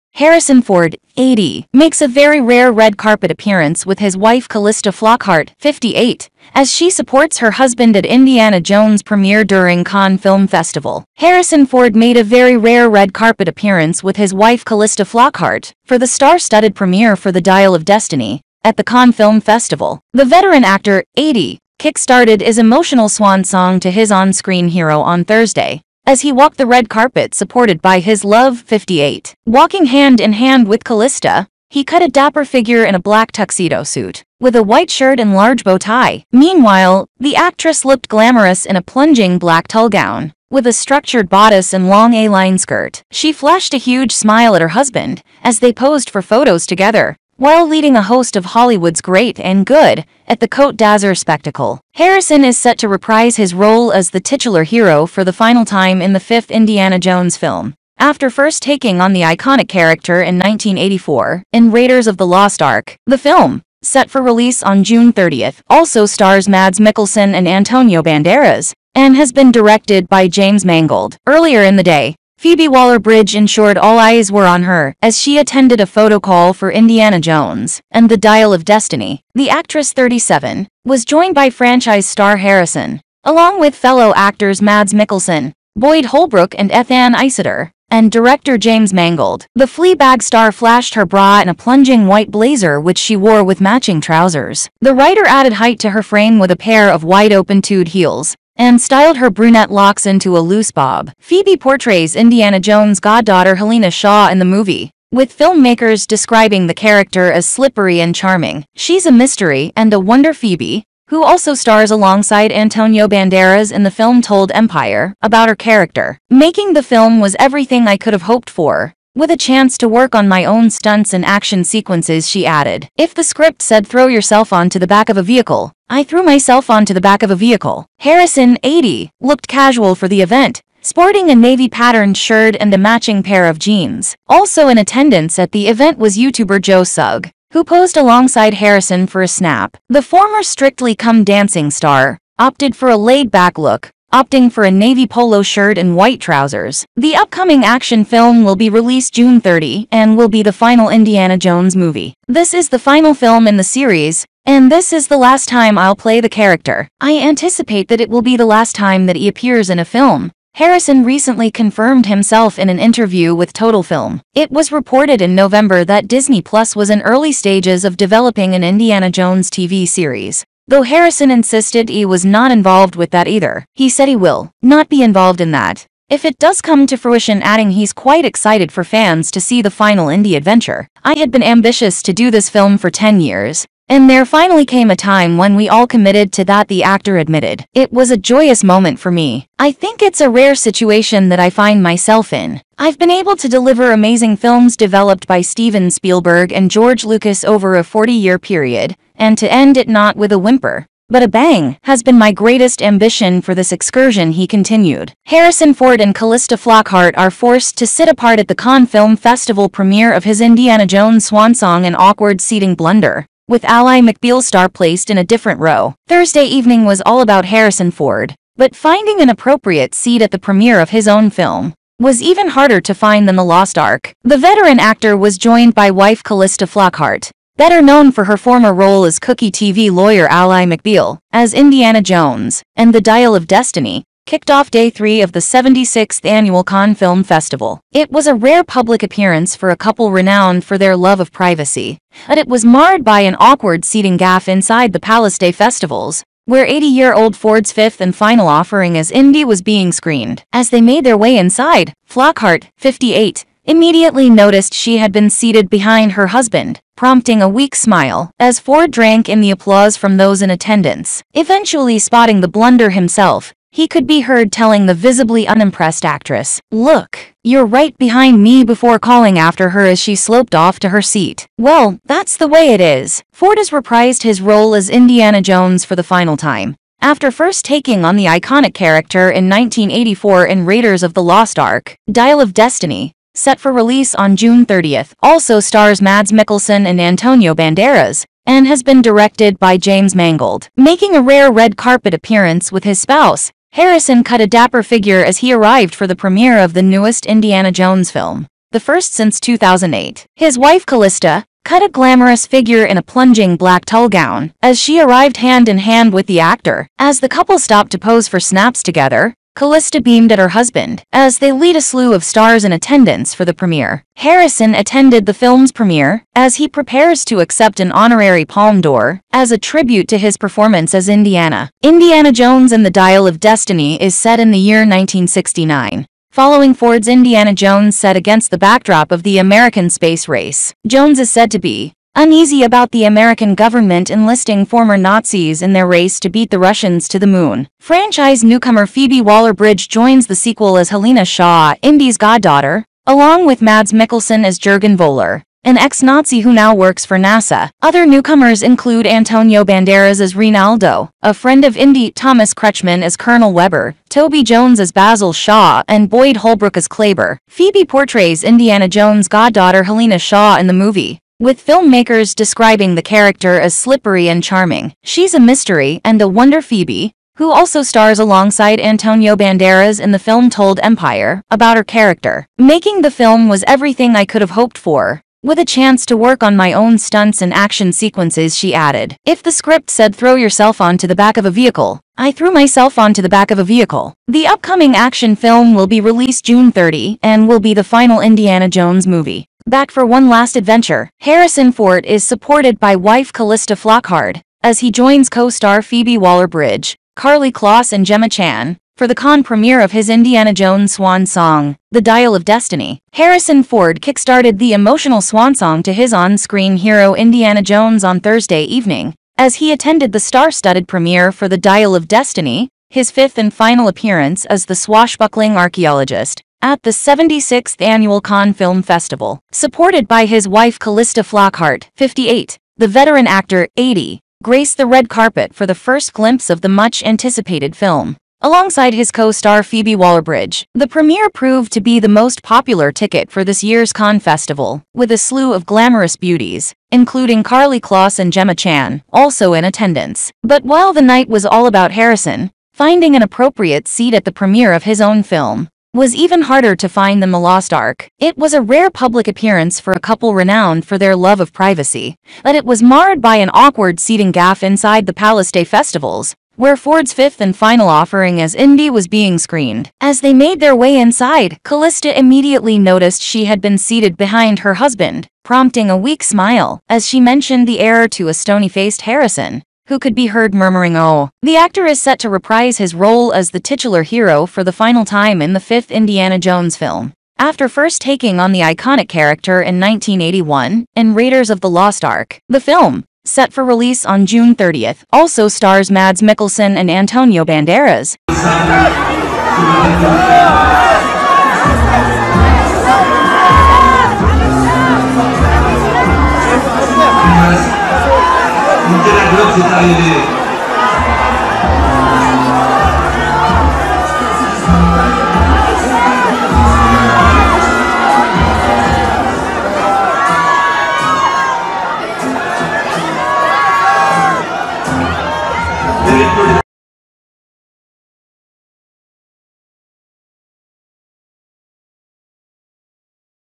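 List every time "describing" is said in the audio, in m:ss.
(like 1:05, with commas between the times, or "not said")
1:46, 6:02.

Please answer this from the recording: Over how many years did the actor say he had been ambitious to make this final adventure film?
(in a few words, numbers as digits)
10.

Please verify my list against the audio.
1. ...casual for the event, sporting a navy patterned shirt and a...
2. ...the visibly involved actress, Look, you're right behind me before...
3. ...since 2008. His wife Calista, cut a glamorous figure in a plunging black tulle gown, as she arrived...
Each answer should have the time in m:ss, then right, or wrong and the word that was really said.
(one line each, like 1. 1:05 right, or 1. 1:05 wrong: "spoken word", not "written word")
1. 2:09 right
2. 4:24 wrong: "unimpressed", not "involved"
3. 4:59 right.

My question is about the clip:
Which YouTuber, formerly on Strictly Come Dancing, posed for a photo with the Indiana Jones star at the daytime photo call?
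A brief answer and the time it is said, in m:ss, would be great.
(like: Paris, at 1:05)
Joe Sugg, at 2:16.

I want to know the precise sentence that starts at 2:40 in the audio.
Harrison recently confirmed himself in an interview with Total Film.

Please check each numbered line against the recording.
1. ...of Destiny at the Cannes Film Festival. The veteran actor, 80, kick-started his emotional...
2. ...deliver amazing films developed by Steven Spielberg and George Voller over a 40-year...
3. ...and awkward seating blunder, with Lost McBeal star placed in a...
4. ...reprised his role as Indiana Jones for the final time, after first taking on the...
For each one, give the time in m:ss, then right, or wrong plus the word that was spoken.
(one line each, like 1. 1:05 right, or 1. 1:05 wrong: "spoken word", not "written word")
1. 0:17 right
2. 3:13 wrong: "Lucas", not "Voller"
3. 3:31 wrong: "Ally", not "Lost"
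4. 4:33 right.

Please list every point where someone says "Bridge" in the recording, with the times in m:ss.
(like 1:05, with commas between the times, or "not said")
1:12, 5:39, 6:36, 7:09.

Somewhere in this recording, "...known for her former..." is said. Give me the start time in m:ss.
3:47.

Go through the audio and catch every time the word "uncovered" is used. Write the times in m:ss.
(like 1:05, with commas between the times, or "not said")
not said.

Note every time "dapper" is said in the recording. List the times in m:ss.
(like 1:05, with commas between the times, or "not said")
0:32, 4:54.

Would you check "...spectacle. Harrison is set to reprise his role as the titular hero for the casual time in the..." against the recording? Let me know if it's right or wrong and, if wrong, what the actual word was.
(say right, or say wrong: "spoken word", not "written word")
wrong: "final", not "casual".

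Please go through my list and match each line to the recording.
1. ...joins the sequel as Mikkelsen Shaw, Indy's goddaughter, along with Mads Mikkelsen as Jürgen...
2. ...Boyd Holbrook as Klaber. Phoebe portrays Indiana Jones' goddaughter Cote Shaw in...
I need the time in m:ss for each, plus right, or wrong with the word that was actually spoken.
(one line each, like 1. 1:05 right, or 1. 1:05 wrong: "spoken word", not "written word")
1. 5:39 wrong: "Helena", not "Mikkelsen"
2. 5:56 wrong: "Helena", not "Cote".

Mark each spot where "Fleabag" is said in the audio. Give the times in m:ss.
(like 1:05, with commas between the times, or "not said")
1:29.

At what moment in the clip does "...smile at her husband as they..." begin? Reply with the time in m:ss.
0:44.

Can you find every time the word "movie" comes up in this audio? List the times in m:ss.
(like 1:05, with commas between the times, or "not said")
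1:44, 2:31, 6:00, 6:29.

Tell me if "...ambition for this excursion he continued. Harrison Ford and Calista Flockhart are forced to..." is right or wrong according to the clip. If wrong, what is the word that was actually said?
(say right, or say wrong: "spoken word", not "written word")
right.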